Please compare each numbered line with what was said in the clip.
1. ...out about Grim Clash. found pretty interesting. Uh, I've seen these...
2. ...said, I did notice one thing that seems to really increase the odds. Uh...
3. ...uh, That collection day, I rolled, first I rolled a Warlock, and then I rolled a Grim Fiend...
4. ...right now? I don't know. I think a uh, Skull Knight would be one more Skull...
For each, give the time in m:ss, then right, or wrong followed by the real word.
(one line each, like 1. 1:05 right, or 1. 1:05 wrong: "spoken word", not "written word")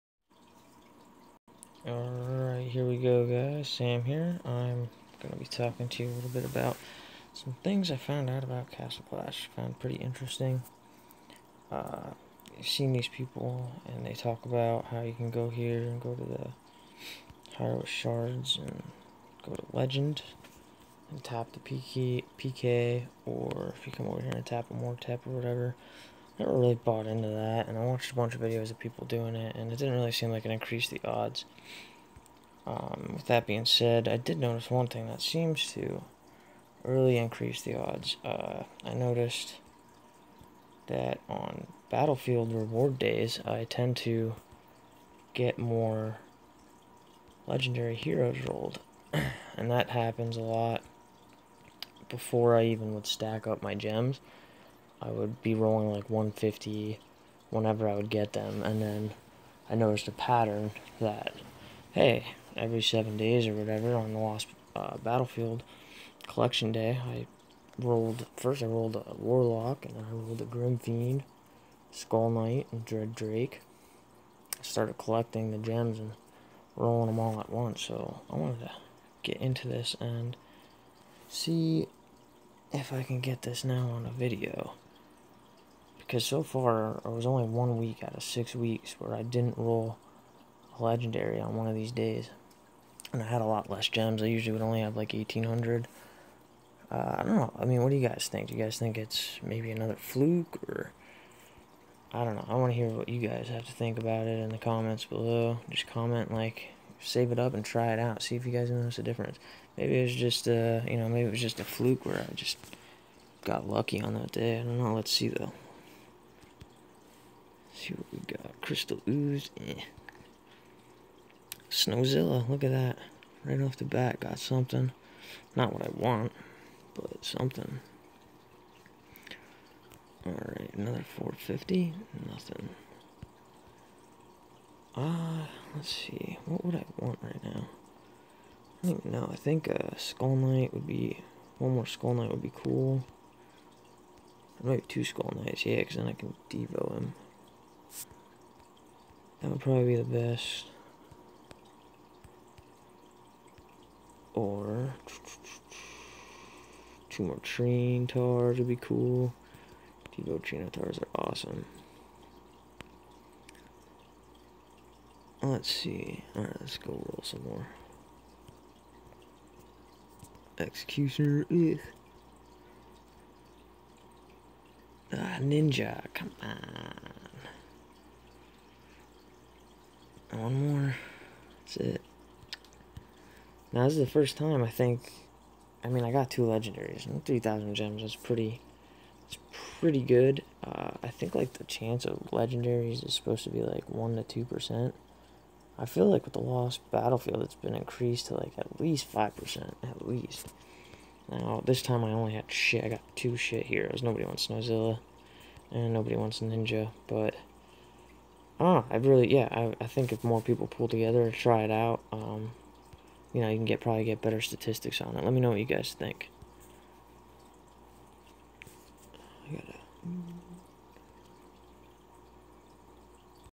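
1. 0:08 wrong: "Castle", not "Grim"
2. 0:33 right
3. 1:04 wrong: "Battlefield", not "That"
4. 2:17 right.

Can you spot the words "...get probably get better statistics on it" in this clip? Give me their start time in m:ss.
3:33.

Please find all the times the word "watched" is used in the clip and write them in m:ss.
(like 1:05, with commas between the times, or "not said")
0:27.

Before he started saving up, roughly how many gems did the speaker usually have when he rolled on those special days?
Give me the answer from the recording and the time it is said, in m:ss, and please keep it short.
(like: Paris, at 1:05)
1,800, at 1:35.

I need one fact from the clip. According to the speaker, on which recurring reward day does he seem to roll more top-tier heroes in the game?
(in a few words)
Battlefield reward days.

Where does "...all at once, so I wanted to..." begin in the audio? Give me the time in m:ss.
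1:17.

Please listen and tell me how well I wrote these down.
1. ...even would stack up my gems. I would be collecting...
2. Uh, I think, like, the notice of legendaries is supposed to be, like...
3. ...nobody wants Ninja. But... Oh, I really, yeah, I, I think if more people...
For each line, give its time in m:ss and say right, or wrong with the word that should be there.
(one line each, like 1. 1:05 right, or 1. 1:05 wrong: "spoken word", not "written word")
1. 0:52 wrong: "rolling", not "collecting"
2. 3:10 wrong: "chance", not "notice"
3. 3:25 right.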